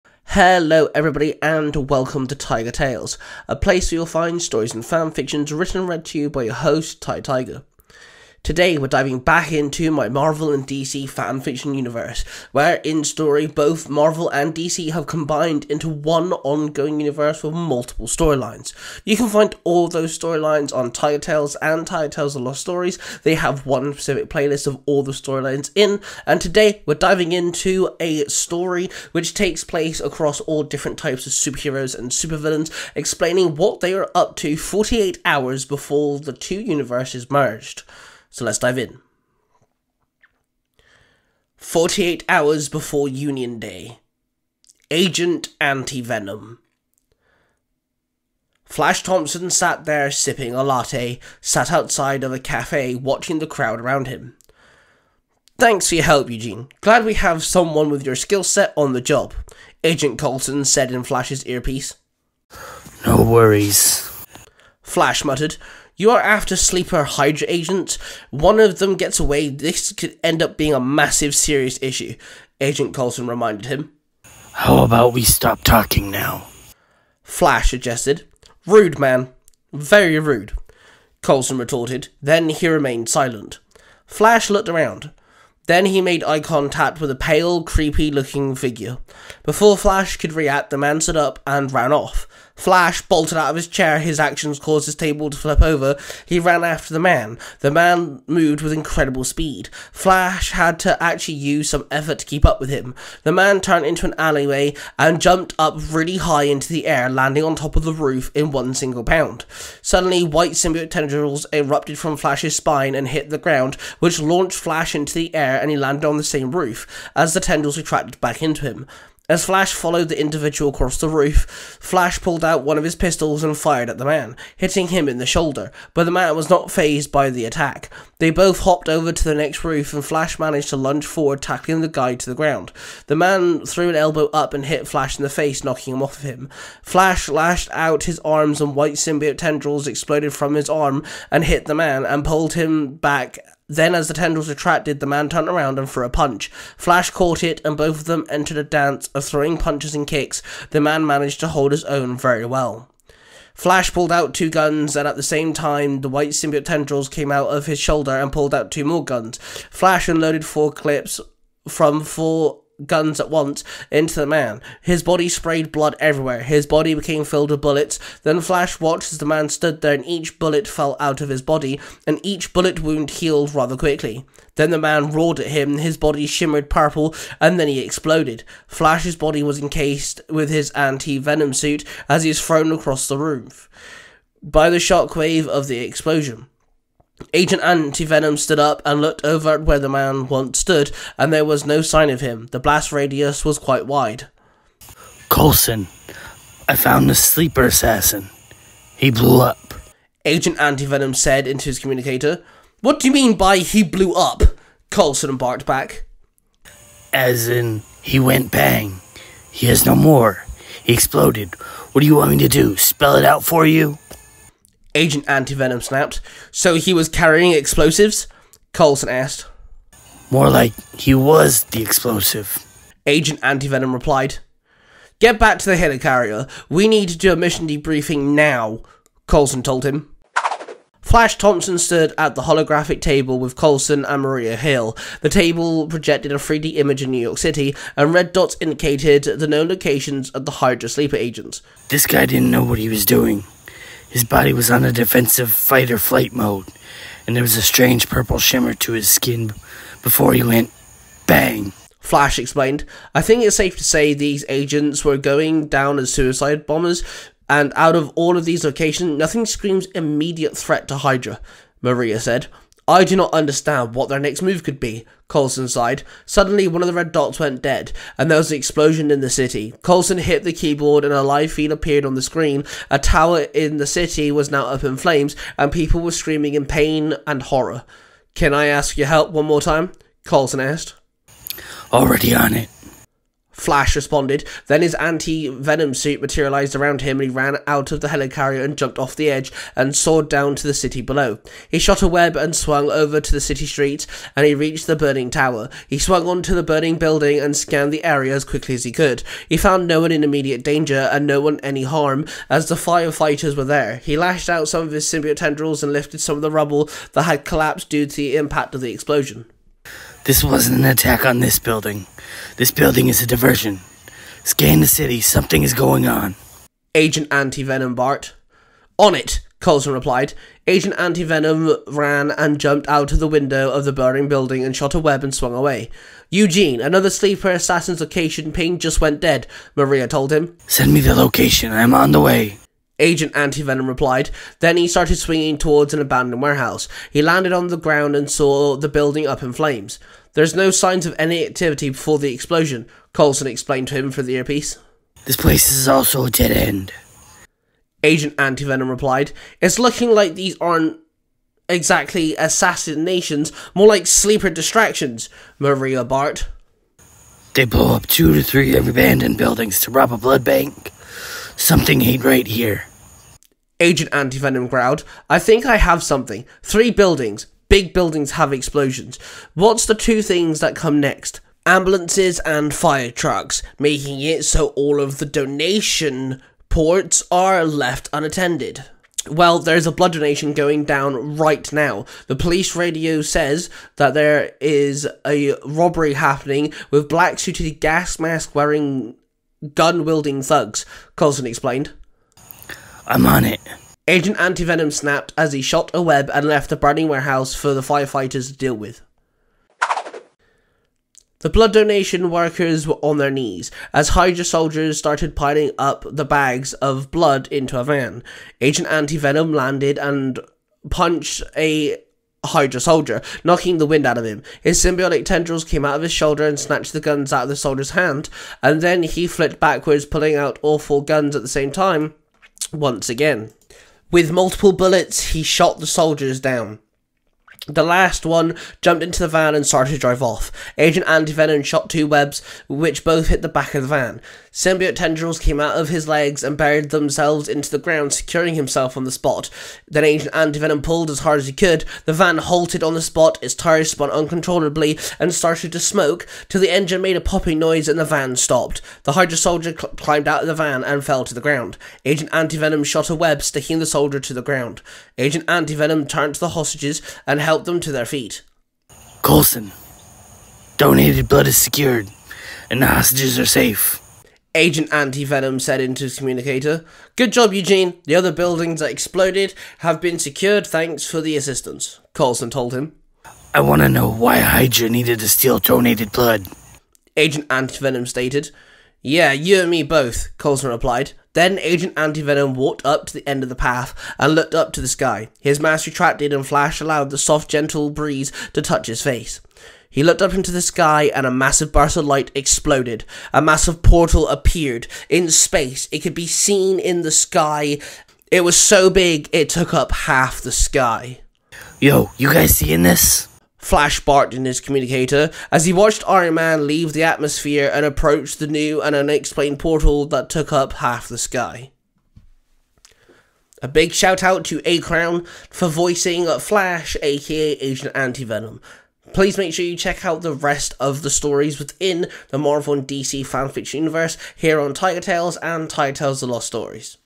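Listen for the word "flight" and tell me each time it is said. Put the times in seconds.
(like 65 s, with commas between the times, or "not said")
245 s.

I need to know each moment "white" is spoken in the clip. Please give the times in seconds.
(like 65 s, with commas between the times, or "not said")
110 s, 138 s, 156 s.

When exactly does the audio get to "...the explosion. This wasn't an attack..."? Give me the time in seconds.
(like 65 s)
308 s.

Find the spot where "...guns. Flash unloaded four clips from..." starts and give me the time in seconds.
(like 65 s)
159 s.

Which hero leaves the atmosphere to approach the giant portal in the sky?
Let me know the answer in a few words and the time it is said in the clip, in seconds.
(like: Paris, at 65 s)
Iron Man, at 506 s.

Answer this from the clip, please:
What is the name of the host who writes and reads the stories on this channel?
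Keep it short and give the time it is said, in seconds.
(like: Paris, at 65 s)
Tai Tiger, at 7 s.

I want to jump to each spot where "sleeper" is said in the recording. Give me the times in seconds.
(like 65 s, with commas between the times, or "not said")
66 s, 197 s, 240 s, 327 s, 354 s.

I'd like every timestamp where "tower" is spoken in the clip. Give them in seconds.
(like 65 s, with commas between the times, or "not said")
272 s, 295 s.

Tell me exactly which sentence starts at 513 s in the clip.
A big shout out to A Crown for voicing Flash, aka Agent Venom.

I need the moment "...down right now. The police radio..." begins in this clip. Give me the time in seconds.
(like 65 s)
380 s.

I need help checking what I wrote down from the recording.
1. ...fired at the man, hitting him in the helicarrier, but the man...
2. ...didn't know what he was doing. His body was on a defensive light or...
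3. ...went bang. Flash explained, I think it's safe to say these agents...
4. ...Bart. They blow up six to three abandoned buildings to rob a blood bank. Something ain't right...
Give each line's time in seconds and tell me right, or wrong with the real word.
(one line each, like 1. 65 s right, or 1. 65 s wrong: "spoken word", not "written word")
1. 123 s wrong: "shoulder", not "helicarrier"
2. 242 s wrong: "fight", not "light"
3. 250 s right
4. 356 s wrong: "two", not "six".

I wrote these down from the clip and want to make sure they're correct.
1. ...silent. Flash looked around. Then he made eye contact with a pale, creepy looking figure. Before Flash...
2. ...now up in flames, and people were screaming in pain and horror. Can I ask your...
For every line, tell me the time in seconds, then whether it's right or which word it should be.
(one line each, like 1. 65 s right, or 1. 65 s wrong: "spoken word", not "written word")
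1. 83 s right
2. 274 s right.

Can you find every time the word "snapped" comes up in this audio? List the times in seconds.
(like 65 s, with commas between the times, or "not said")
215 s, 394 s.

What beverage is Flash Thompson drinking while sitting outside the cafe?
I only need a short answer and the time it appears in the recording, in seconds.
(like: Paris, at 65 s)
latte, at 50 s.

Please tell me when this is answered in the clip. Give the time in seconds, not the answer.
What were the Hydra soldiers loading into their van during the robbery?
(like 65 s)
406 s.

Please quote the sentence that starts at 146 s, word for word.
Flash caught it, and both of them entered a dance of throwing punches and kicks.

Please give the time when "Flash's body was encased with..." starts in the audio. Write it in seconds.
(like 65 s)
178 s.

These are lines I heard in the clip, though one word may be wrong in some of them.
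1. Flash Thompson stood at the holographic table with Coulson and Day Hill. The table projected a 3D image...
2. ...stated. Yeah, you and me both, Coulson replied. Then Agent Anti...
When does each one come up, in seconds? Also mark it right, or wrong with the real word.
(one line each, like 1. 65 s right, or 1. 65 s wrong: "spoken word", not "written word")
1. 231 s wrong: "Maria", not "Day"
2. 478 s right.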